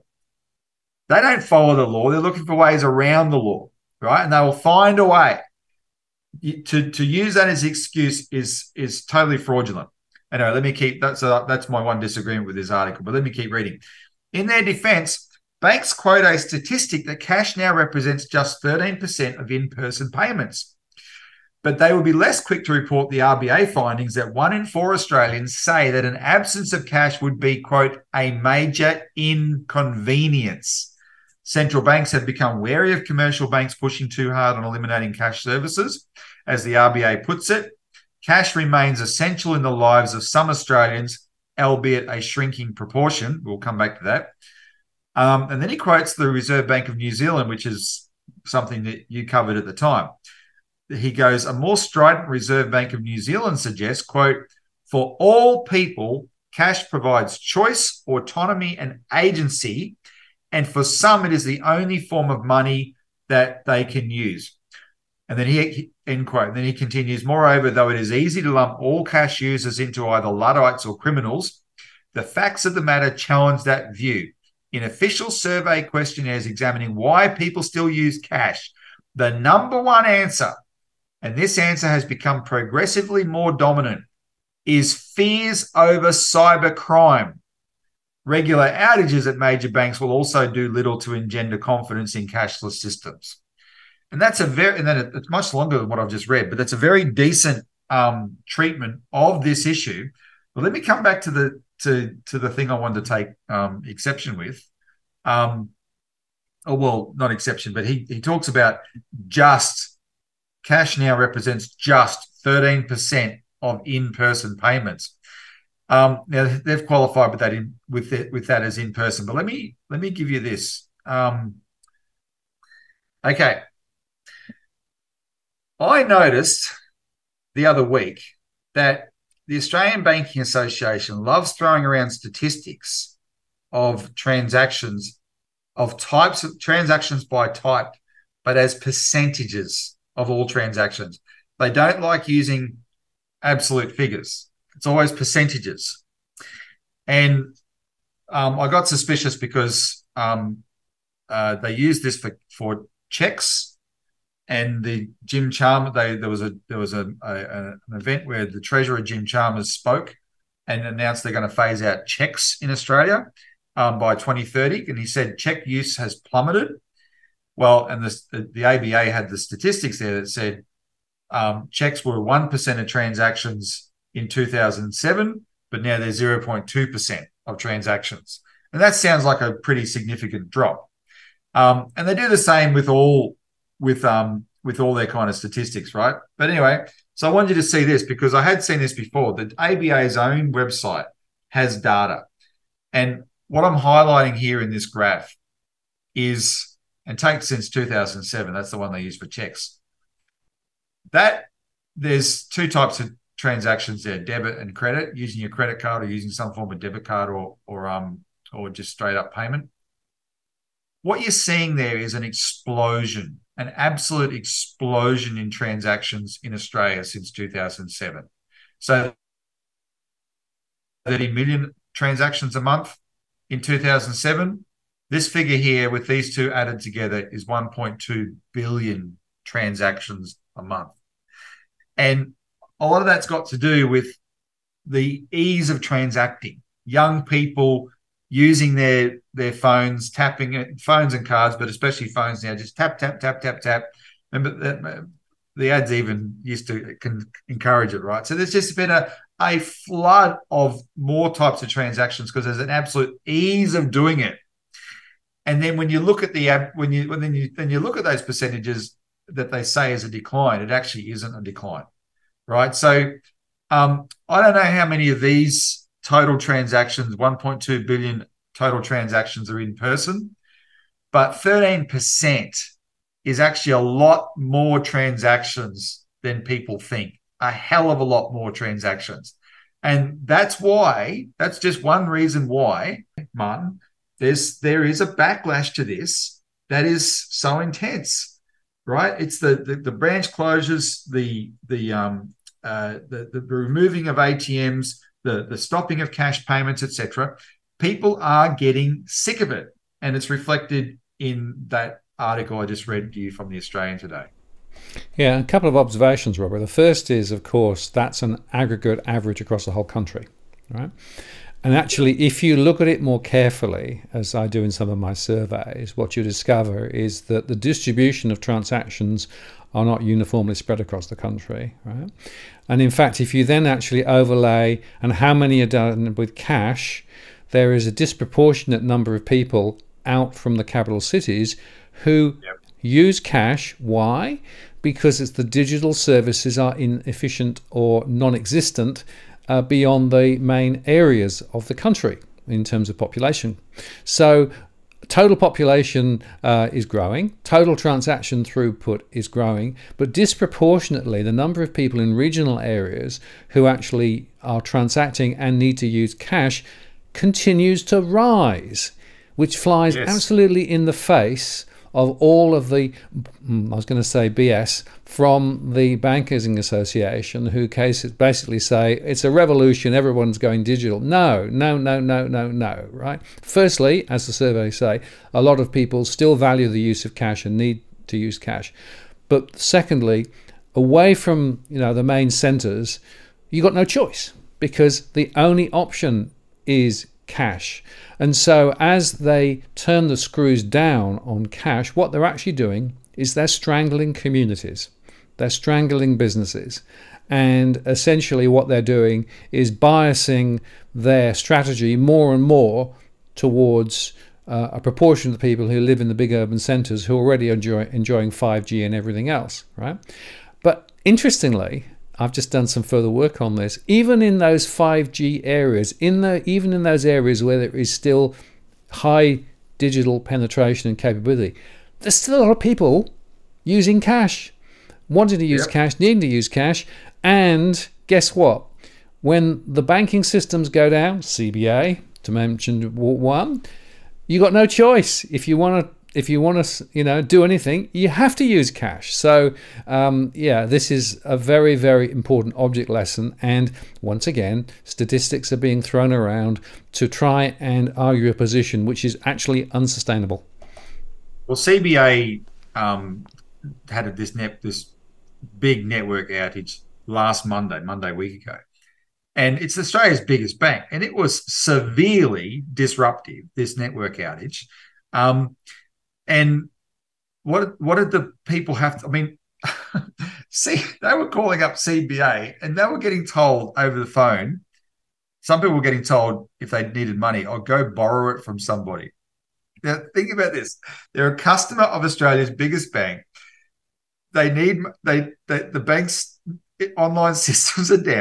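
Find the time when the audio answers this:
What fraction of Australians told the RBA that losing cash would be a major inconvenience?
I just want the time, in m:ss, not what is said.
0:24.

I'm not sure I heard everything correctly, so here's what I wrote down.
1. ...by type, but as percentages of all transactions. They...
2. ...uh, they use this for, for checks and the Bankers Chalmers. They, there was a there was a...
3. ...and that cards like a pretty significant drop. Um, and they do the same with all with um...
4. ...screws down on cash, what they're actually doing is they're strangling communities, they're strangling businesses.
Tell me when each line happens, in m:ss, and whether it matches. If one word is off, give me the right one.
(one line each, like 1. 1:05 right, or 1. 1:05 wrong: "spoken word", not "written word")
1. 2:17 right
2. 2:31 wrong: "Jim", not "Bankers"
3. 2:58 wrong: "sounds", not "cards"
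4. 6:30 right.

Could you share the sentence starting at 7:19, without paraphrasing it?
So um, yeah, this is a very, very important object lesson.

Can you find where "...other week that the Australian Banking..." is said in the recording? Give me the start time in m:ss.
2:07.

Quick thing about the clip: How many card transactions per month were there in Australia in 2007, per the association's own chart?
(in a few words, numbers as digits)
30 million.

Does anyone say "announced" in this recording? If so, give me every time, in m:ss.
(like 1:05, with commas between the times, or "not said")
2:40.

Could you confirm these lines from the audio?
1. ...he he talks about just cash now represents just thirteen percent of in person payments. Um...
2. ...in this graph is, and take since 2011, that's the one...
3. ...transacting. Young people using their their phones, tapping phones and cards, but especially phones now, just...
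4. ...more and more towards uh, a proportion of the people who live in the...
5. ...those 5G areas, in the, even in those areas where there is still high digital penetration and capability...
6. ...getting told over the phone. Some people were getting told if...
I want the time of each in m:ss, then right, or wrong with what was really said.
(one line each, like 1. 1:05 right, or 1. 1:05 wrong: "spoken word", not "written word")
1. 1:47 right
2. 3:14 wrong: "2007", not "2011"
3. 3:55 right
4. 6:41 right
5. 6:54 right
6. 7:52 right.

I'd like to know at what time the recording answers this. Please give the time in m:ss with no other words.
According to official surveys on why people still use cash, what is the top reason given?
1:24.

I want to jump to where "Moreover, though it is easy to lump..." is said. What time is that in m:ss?
1:07.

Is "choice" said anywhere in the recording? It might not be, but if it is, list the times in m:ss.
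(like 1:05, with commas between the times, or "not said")
0:57, 6:23, 7:14.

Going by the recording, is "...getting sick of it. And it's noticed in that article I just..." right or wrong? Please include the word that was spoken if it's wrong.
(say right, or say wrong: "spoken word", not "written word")
wrong: "reflected", not "noticed".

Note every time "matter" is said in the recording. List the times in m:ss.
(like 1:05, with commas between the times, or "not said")
1:12.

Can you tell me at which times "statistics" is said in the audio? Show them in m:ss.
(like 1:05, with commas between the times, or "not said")
0:16, 2:12, 2:49, 3:05, 7:24.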